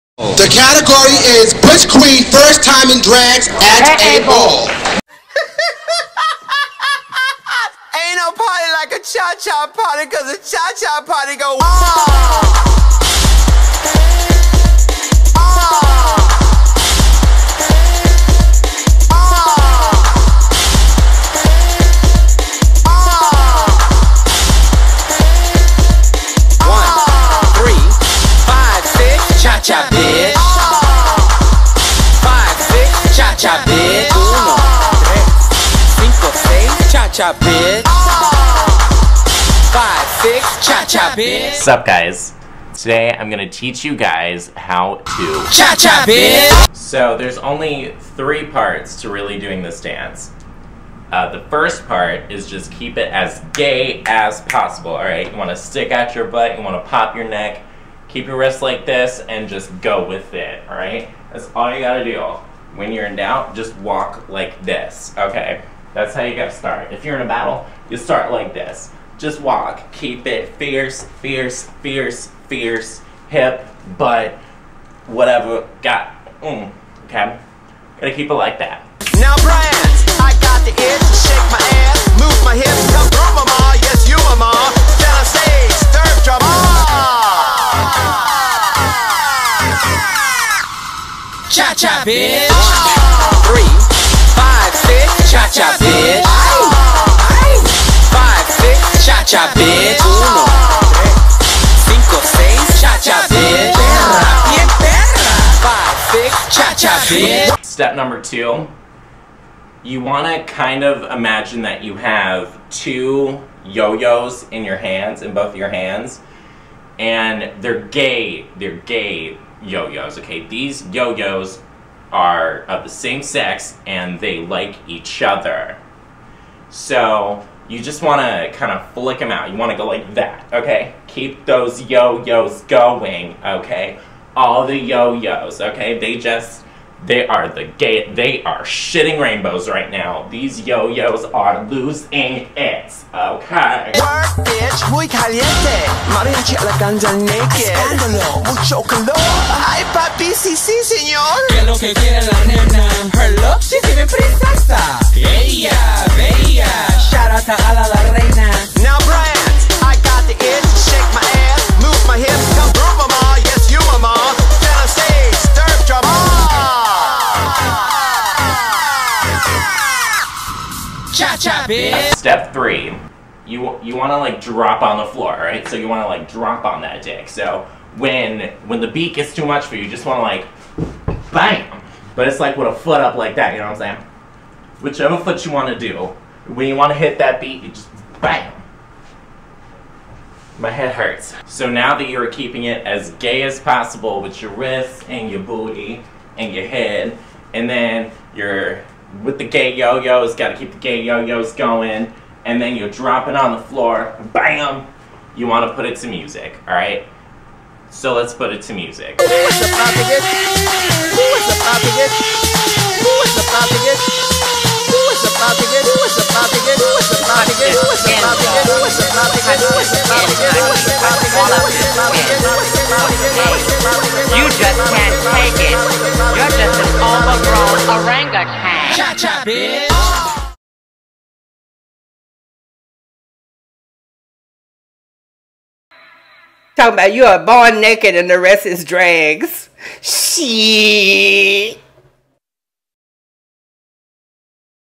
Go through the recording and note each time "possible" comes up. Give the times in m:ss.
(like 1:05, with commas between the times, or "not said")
0:54, 3:13.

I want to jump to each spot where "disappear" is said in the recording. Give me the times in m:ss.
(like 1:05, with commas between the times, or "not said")
not said.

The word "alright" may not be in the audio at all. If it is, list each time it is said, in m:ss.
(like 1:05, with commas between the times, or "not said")
0:54, 1:00, 3:26.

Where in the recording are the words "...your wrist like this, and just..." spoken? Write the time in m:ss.
0:58.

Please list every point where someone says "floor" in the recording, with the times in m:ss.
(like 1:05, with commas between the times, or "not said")
2:55, 3:23.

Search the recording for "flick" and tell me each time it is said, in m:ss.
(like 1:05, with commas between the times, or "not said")
2:08.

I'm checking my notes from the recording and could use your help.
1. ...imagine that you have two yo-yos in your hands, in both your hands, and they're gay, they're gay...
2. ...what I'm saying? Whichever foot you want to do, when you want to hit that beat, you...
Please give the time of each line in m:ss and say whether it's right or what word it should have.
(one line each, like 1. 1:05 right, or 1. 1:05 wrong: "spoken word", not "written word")
1. 1:51 right
2. 3:03 right.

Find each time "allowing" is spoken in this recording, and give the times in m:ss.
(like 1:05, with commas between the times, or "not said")
not said.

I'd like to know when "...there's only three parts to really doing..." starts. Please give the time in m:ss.
0:47.